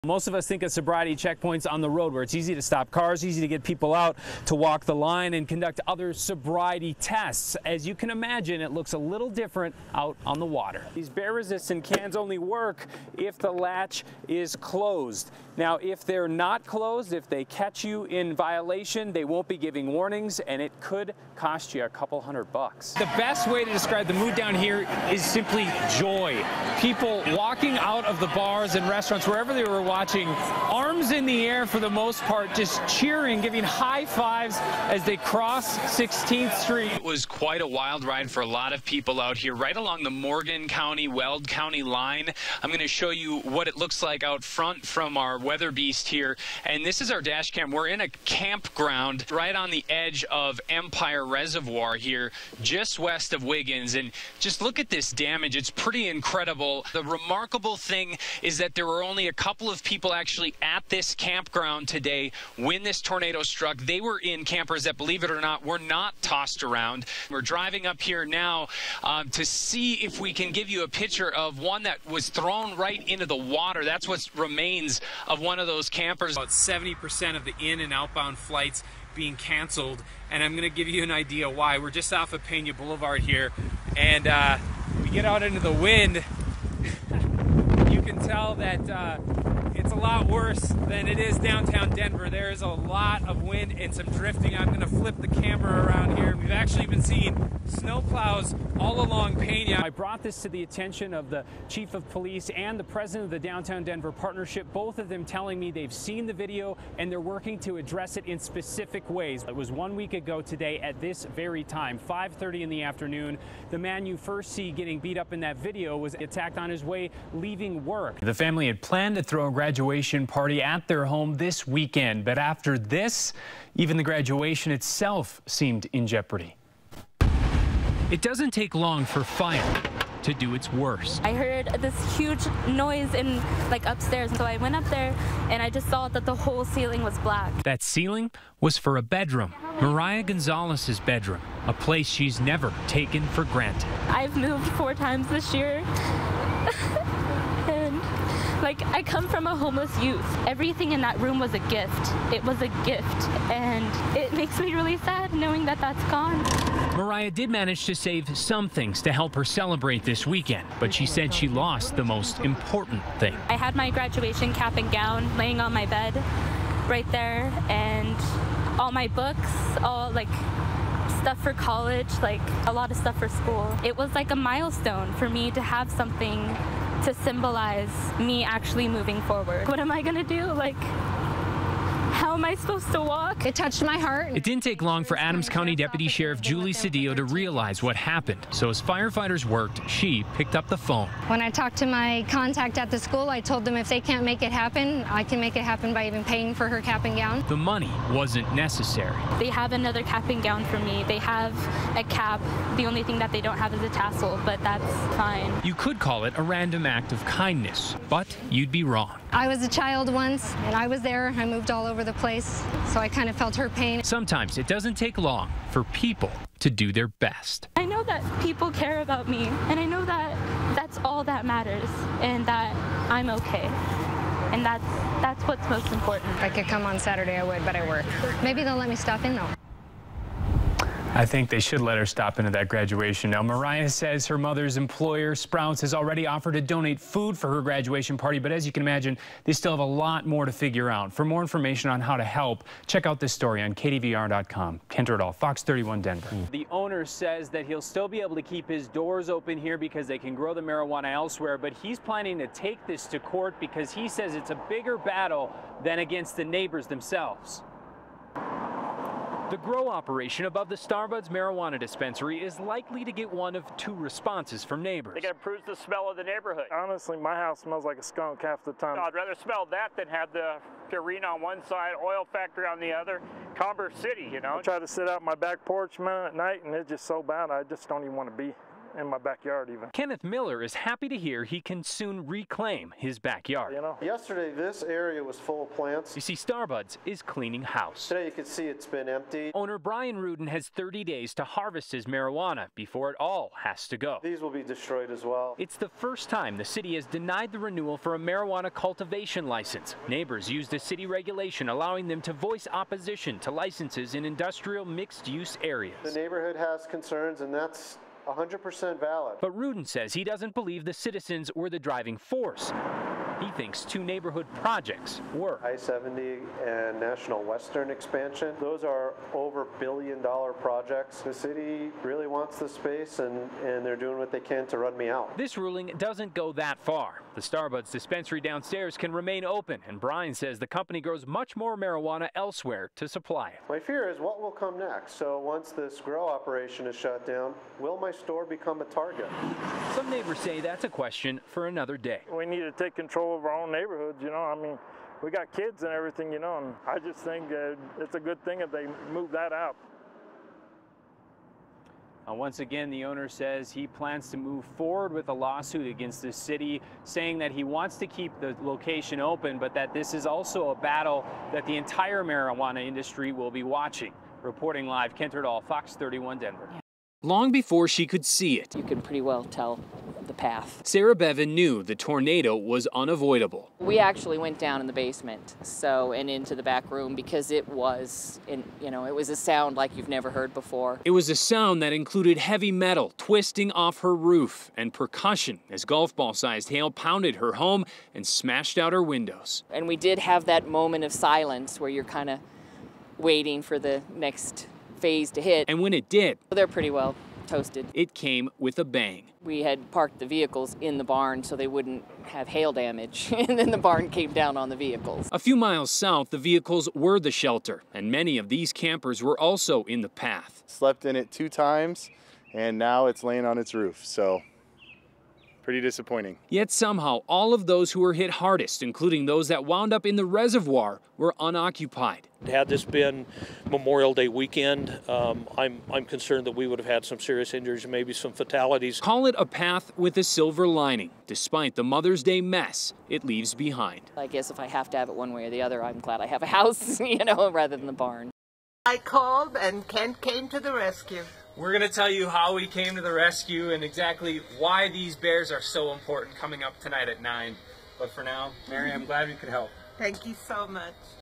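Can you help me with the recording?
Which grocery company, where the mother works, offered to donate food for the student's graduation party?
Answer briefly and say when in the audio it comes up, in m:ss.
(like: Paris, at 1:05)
Sprouts, at 3:55.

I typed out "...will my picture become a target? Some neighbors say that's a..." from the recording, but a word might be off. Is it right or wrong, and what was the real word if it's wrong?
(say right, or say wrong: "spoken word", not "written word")
wrong: "store", not "picture".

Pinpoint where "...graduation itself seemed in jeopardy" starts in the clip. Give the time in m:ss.
2:04.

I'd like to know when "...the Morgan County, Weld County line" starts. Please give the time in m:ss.
0:40.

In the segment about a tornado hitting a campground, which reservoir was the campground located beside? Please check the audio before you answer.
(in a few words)
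Empire Reservoir.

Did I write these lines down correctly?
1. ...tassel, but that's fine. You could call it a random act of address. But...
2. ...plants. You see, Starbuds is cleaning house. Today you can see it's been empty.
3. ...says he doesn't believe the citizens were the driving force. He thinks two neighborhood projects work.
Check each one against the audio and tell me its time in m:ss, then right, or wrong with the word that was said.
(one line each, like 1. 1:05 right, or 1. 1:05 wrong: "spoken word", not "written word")
1. 3:23 wrong: "kindness", not "address"
2. 4:45 right
3. 5:09 right.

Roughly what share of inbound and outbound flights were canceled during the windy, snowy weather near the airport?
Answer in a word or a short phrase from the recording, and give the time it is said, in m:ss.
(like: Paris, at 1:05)
70%, at 1:16.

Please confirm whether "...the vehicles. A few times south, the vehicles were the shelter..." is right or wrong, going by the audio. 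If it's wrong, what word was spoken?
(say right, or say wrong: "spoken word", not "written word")
wrong: "miles", not "times".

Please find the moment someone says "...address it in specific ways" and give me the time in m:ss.
1:47.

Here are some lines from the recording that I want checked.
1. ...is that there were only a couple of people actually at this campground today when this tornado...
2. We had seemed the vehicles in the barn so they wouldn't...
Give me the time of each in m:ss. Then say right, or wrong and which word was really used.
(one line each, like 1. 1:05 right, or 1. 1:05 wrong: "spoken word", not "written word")
1. 0:58 right
2. 6:39 wrong: "parked", not "seemed".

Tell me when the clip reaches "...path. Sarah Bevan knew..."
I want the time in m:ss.
6:10.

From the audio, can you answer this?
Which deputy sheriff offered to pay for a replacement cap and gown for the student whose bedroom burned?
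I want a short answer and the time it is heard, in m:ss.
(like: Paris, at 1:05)
Julie Cedillo, at 3:06.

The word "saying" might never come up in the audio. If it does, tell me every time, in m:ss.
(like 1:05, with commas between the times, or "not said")
5:57.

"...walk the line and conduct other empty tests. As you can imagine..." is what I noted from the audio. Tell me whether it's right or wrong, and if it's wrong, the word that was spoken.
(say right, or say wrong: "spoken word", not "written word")
wrong: "sobriety", not "empty".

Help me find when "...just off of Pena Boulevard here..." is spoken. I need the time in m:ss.
1:21.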